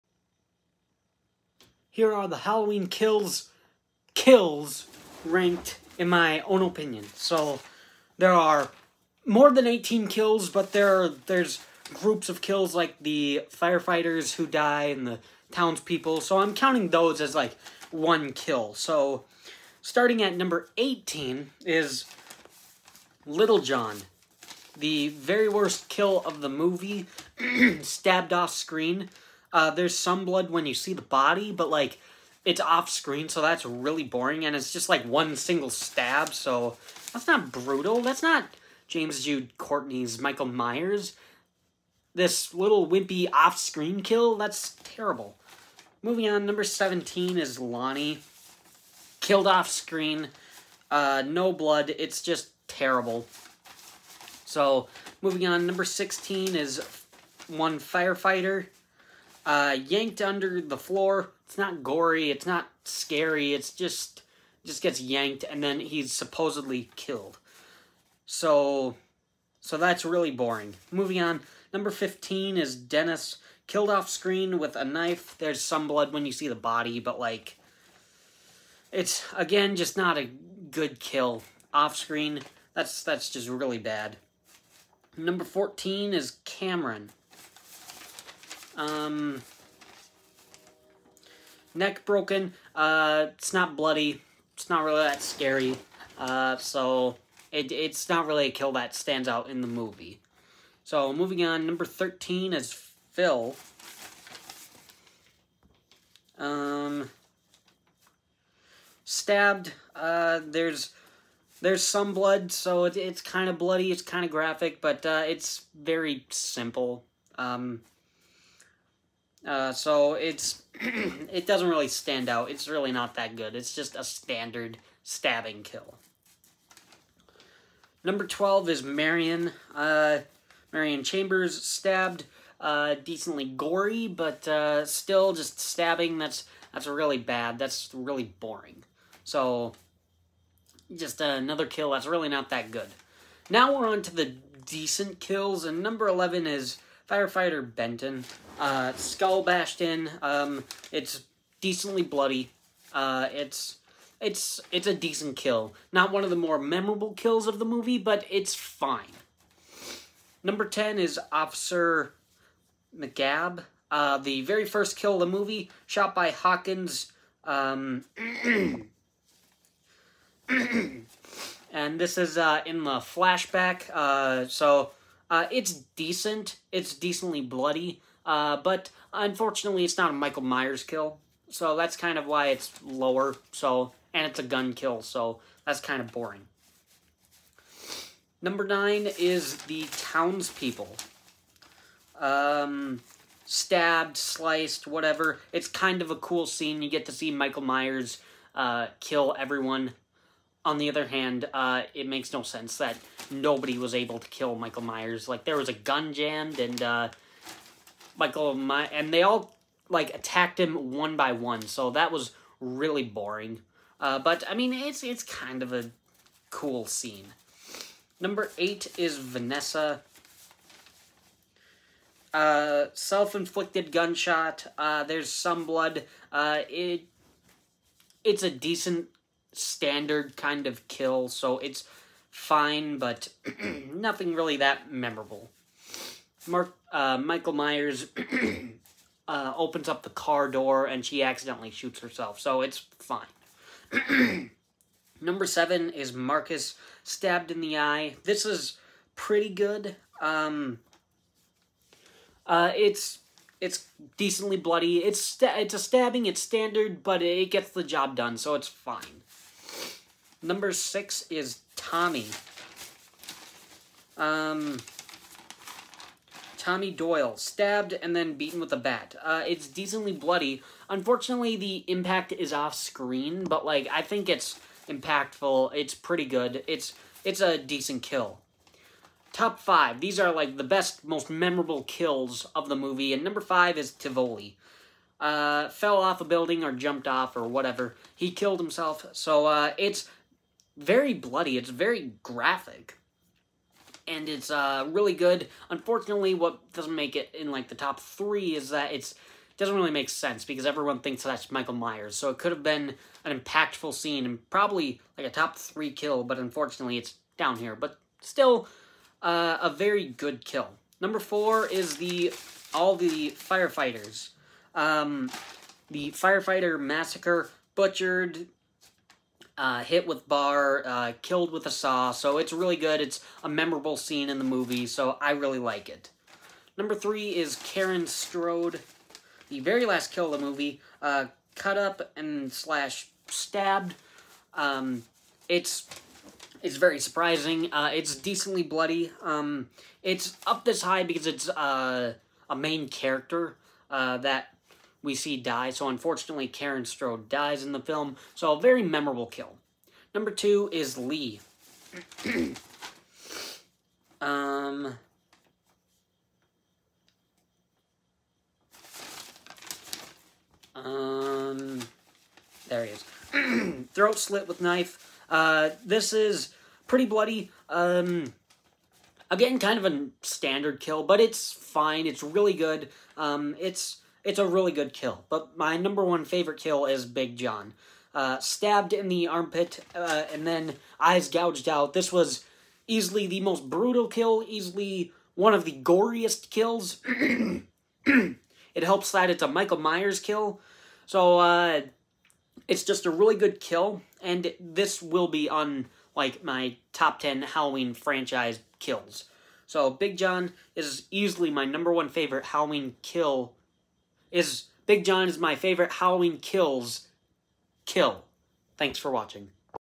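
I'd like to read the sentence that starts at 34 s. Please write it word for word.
And it's just like one single stab, so that's not brutal.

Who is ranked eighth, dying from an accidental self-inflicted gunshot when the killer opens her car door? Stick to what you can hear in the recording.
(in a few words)
Vanessa.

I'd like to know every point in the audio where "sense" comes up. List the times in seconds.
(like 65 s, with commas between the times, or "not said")
202 s, 300 s.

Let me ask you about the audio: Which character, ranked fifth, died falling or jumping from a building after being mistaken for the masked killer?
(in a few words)
Tivoli.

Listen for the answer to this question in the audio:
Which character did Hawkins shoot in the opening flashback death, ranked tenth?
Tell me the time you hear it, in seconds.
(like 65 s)
161 s.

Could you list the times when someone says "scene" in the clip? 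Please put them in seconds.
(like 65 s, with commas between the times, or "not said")
196 s, 216 s, 303 s, 323 s.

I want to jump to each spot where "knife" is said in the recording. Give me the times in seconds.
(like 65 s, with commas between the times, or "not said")
74 s, 364 s.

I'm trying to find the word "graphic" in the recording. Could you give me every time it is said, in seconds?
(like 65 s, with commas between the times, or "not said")
114 s, 292 s.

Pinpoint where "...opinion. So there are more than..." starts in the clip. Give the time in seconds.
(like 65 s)
6 s.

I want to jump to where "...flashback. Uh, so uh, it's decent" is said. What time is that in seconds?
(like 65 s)
172 s.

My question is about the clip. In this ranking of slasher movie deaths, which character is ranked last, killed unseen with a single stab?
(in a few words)
Little John.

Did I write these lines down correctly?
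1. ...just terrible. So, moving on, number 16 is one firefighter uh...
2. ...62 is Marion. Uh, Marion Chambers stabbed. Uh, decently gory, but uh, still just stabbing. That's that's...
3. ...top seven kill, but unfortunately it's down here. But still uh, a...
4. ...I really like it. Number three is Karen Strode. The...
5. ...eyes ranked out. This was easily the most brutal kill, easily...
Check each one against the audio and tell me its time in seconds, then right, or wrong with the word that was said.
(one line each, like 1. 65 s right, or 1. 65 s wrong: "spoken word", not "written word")
1. 52 s right
2. 128 s wrong: "12", not "62"
3. 305 s wrong: "three", not "seven"
4. 325 s right
5. 380 s wrong: "gouged", not "ranked".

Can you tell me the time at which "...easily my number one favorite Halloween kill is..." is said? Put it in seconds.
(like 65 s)
401 s.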